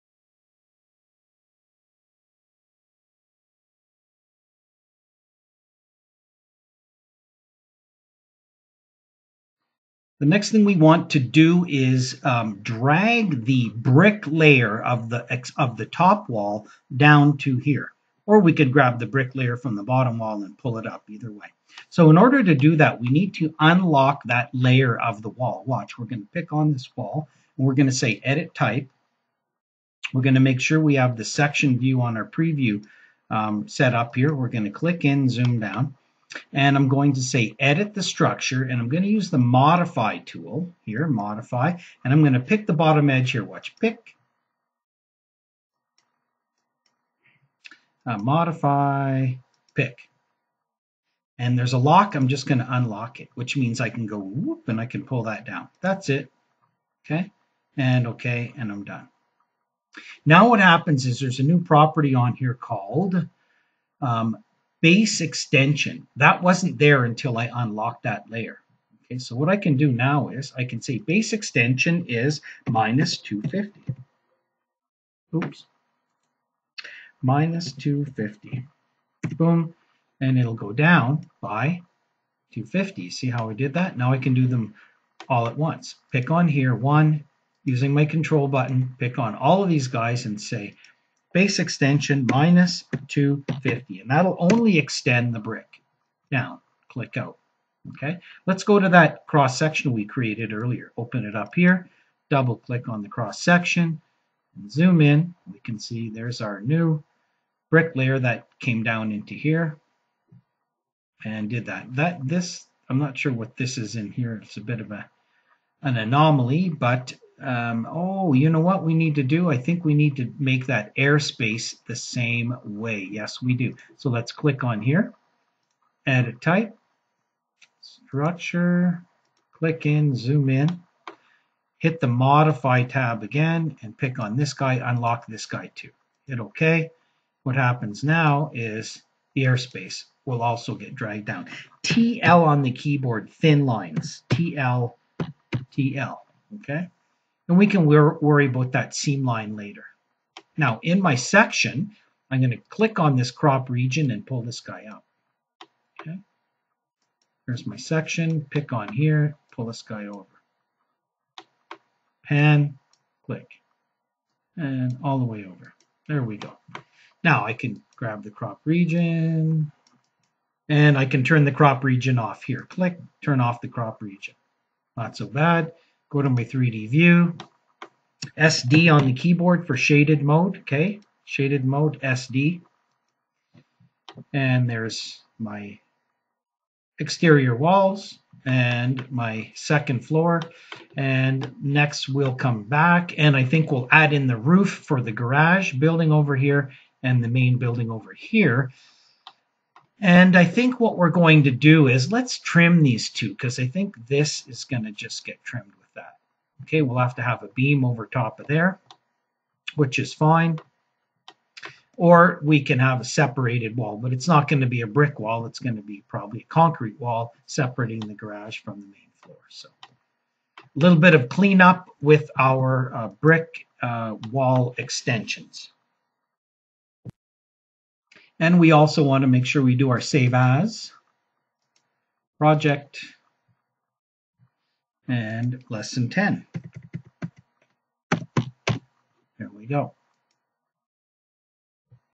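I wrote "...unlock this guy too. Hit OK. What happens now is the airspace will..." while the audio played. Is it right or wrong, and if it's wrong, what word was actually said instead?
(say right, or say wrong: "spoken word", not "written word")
right.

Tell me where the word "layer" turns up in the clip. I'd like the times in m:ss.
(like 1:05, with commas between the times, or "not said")
0:14, 0:19, 0:24, 1:08, 1:47.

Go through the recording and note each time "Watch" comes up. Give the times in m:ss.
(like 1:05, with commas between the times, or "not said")
0:25, 0:43.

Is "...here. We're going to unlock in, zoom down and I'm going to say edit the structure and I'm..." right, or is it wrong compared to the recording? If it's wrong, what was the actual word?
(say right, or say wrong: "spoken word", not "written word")
wrong: "click", not "unlock".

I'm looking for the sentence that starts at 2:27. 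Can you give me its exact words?
and we can wor worry about that seam line later.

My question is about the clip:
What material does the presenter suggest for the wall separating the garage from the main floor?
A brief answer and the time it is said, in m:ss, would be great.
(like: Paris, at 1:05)
concrete, at 3:36.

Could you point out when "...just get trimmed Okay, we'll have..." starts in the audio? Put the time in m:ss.
3:24.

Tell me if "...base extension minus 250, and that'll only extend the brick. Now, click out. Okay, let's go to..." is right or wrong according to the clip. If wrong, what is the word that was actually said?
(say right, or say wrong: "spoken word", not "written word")
right.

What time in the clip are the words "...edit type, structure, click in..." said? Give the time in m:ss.
2:06.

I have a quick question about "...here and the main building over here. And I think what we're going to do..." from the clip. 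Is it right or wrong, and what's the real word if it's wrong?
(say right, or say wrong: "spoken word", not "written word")
right.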